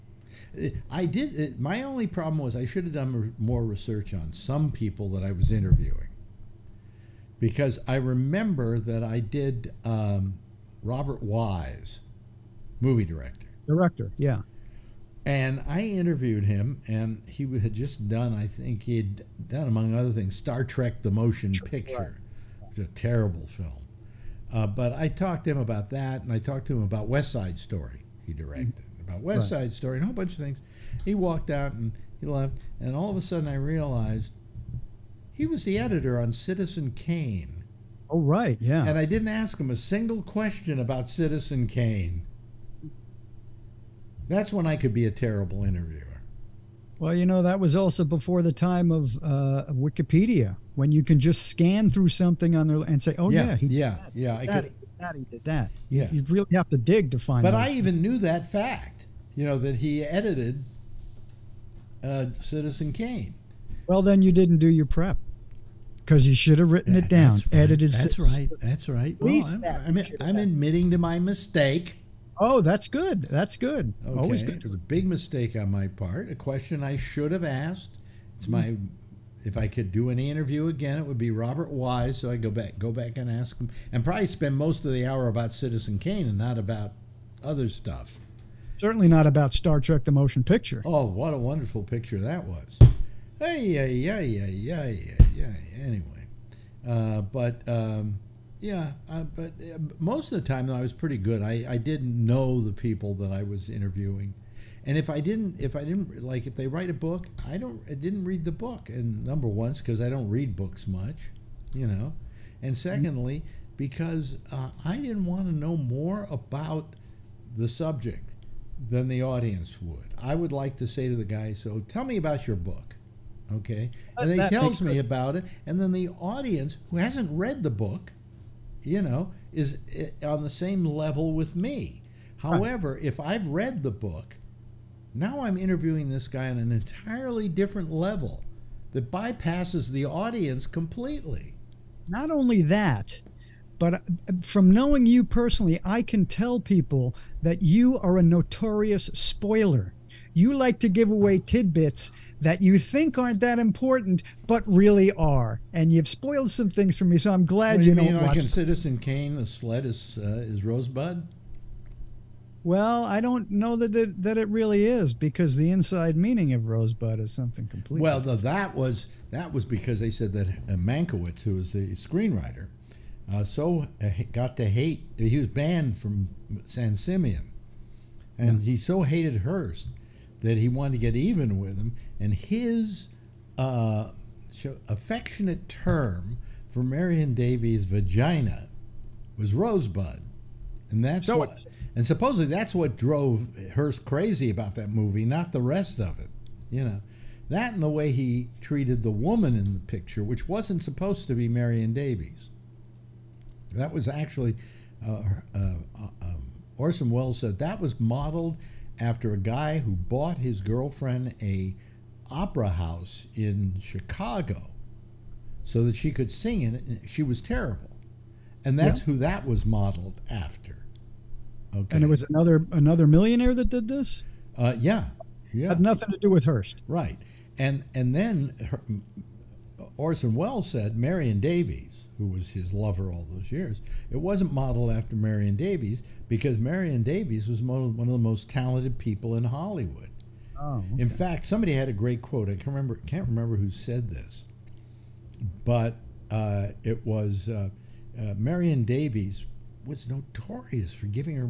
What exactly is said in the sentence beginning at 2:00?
I would like to say to the guy, so tell me about your book okay?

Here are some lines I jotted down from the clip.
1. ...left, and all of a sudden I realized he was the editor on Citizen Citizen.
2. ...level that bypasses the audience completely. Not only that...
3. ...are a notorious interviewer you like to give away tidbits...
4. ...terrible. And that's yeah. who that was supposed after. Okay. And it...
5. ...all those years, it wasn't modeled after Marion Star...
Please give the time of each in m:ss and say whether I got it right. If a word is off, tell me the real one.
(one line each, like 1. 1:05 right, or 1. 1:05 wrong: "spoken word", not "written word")
1. 0:32 wrong: "Kane", not "Citizen"
2. 2:17 right
3. 2:27 wrong: "spoiler", not "interviewer"
4. 3:37 wrong: "modeled", not "supposed"
5. 3:53 wrong: "Davies", not "Star".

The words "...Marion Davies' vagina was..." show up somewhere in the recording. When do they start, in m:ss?
3:06.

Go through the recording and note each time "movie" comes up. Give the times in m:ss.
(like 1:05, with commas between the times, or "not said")
0:12, 3:14.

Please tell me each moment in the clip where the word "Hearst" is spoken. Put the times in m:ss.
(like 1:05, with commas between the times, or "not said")
2:59, 3:13, 3:46.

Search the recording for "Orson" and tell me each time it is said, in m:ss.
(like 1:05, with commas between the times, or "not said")
3:26, 3:49.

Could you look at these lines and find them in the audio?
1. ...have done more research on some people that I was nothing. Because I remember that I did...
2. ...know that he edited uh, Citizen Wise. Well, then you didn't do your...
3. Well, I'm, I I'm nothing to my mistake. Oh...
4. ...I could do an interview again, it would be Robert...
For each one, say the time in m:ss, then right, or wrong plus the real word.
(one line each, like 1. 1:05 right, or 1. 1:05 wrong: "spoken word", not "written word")
1. 0:02 wrong: "interviewing", not "nothing"
2. 0:59 wrong: "Kane", not "Wise"
3. 1:09 wrong: "admitting", not "nothing"
4. 1:19 right.